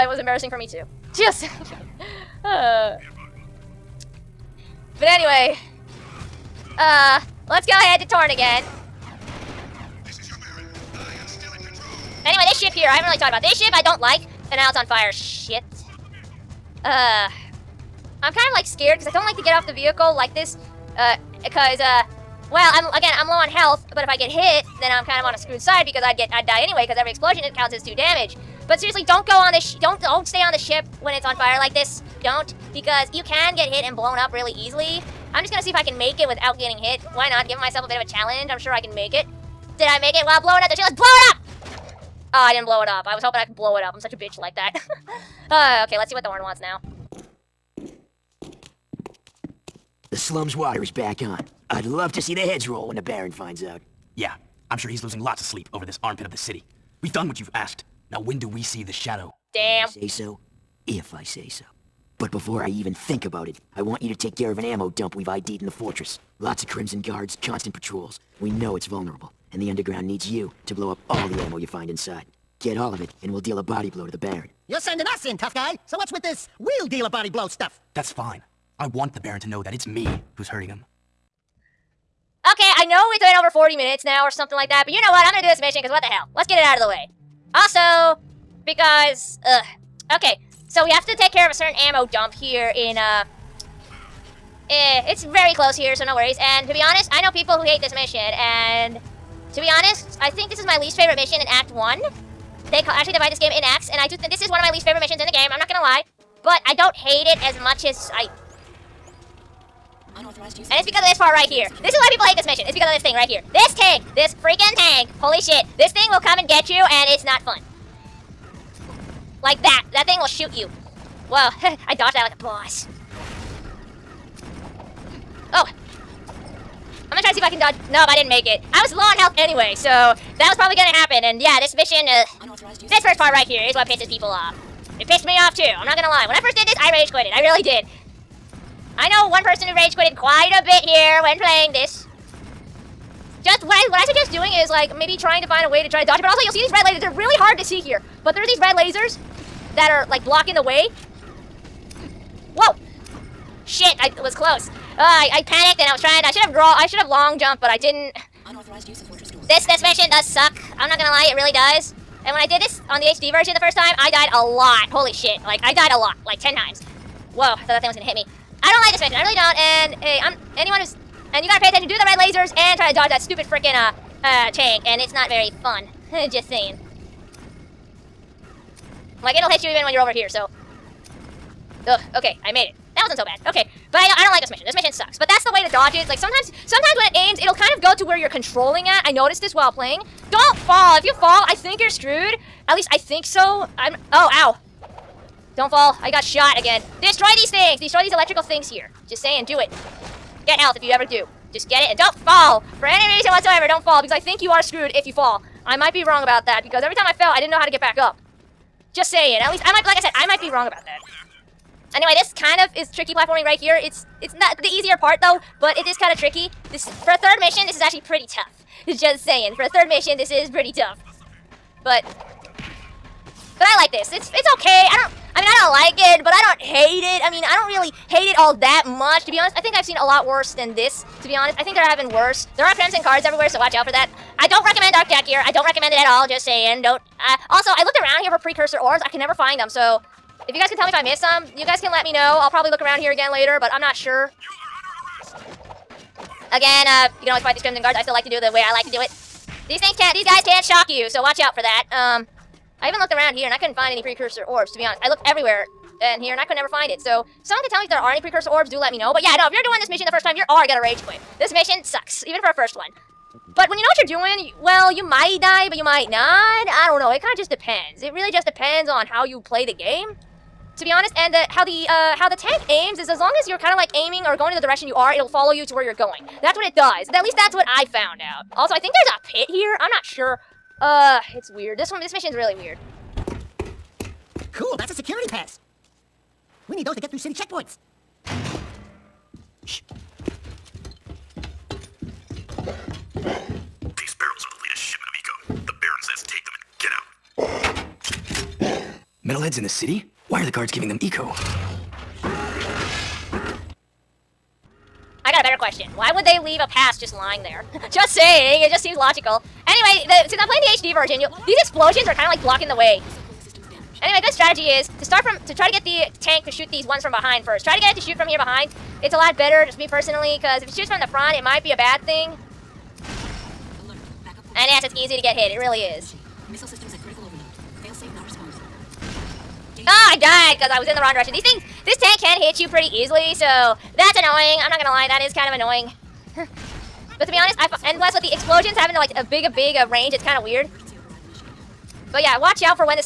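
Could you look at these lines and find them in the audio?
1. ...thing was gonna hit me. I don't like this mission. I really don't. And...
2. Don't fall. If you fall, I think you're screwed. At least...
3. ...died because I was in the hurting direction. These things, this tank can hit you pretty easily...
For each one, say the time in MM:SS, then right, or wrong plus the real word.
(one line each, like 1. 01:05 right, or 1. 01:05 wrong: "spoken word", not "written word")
1. 02:47 right
2. 03:10 right
3. 05:30 wrong: "wrong", not "hurting".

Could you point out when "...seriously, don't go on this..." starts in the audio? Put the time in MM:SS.
00:28.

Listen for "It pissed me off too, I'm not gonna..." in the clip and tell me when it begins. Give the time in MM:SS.
02:14.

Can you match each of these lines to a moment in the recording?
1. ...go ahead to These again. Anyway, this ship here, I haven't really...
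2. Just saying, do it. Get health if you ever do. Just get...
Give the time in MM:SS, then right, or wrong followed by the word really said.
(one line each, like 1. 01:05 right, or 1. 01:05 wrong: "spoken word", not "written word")
1. 00:07 wrong: "Torn", not "These"
2. 03:19 right.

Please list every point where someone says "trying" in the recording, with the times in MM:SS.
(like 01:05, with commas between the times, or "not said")
02:25, 02:36.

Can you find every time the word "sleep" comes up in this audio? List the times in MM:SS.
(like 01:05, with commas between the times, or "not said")
00:55.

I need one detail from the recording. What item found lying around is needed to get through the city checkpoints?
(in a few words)
security pass.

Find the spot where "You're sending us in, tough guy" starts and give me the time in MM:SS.
01:14.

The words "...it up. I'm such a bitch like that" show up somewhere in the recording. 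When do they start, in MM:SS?
00:43.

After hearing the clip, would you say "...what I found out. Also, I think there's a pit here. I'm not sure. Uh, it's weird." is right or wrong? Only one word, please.
right.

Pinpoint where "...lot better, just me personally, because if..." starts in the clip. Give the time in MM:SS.
05:19.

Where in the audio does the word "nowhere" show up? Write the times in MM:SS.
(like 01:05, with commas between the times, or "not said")
not said.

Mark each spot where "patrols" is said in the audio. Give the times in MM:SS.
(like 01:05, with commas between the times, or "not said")
01:07.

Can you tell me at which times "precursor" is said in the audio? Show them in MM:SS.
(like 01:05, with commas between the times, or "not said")
03:58, 04:14, 04:18.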